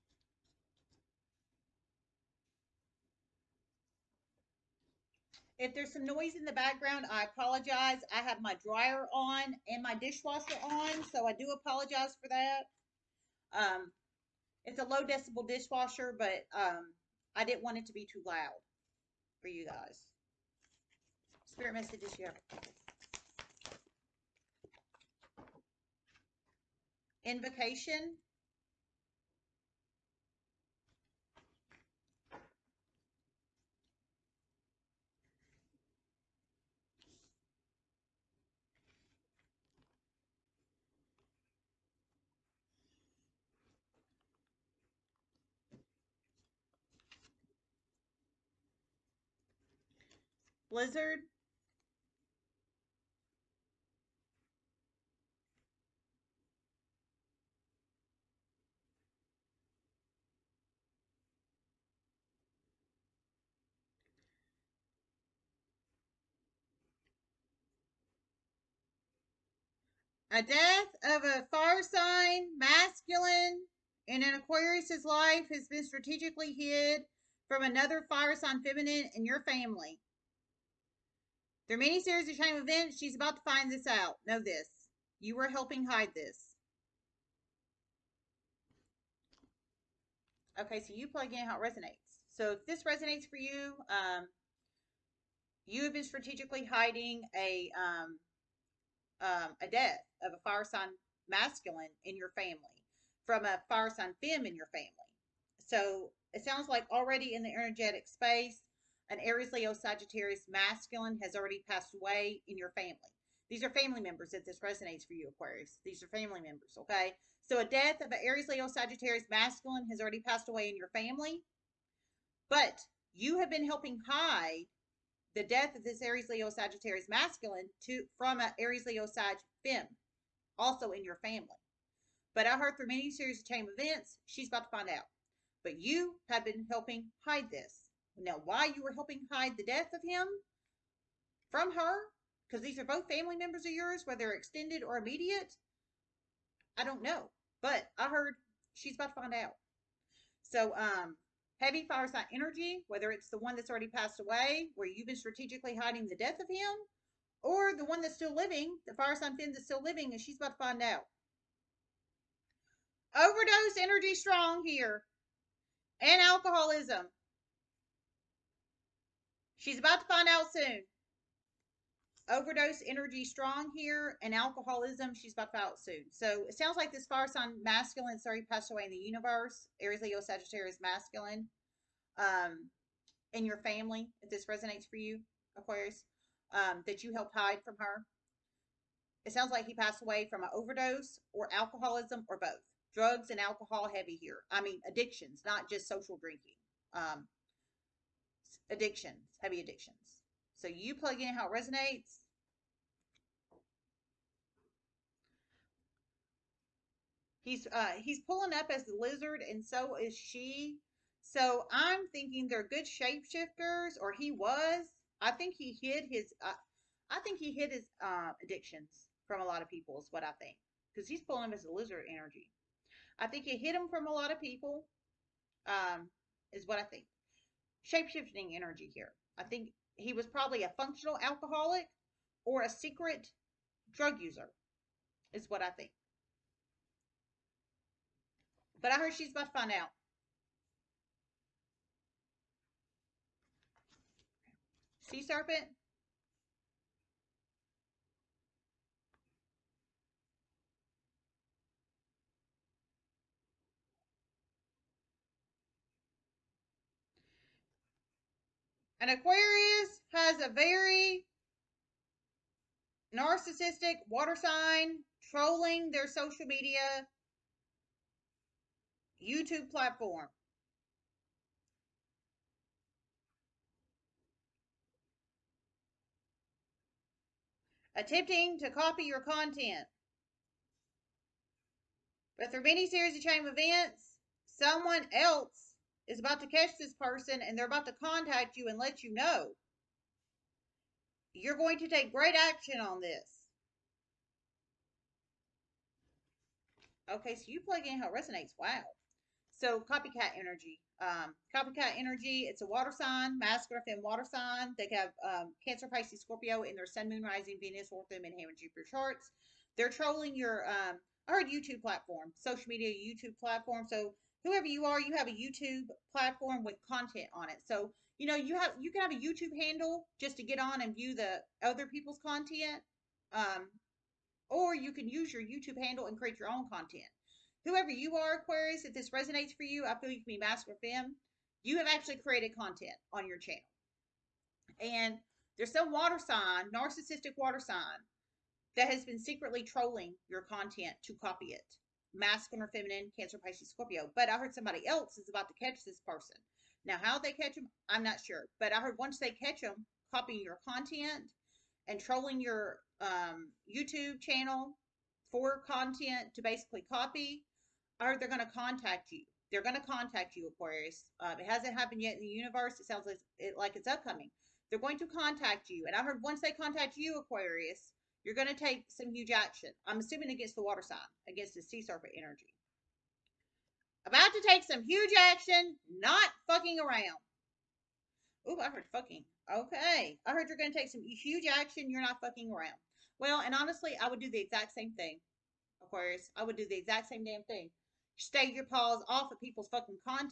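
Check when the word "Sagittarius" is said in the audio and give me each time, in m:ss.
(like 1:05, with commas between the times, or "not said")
1:49, 1:58, 2:06, 3:00.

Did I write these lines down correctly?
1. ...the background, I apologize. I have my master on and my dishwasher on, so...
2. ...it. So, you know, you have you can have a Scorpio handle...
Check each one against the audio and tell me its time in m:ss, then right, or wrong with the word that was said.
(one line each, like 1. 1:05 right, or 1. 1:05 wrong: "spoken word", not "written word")
1. 0:06 wrong: "dryer", not "master"
2. 5:17 wrong: "YouTube", not "Scorpio".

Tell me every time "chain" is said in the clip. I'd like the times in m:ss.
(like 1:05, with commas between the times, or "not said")
2:13, 4:43.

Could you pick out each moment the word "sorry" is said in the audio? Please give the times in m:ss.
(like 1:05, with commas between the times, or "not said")
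2:58.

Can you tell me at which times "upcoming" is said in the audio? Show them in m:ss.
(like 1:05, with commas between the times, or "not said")
6:03.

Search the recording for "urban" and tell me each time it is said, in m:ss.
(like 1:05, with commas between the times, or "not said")
not said.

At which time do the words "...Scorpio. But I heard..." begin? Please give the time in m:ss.
5:43.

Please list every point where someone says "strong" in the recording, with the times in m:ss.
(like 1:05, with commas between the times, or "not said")
2:44, 2:53.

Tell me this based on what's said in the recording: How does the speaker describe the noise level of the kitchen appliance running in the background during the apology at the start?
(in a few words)
low decibel.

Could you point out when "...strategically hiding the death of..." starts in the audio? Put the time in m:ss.
2:35.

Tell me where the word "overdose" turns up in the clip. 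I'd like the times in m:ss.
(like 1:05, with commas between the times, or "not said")
2:43, 2:52, 3:10.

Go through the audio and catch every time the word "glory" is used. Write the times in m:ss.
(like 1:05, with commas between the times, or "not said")
not said.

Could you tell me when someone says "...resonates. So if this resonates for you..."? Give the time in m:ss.
1:31.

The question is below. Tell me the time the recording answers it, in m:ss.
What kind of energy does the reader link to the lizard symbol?
3:47.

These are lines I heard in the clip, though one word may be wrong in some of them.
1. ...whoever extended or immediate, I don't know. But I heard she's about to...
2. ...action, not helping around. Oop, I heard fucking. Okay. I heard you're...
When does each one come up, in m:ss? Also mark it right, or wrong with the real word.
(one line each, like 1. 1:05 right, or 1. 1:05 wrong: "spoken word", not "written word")
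1. 2:24 wrong: "whether", not "whoever"
2. 6:15 wrong: "fucking", not "helping".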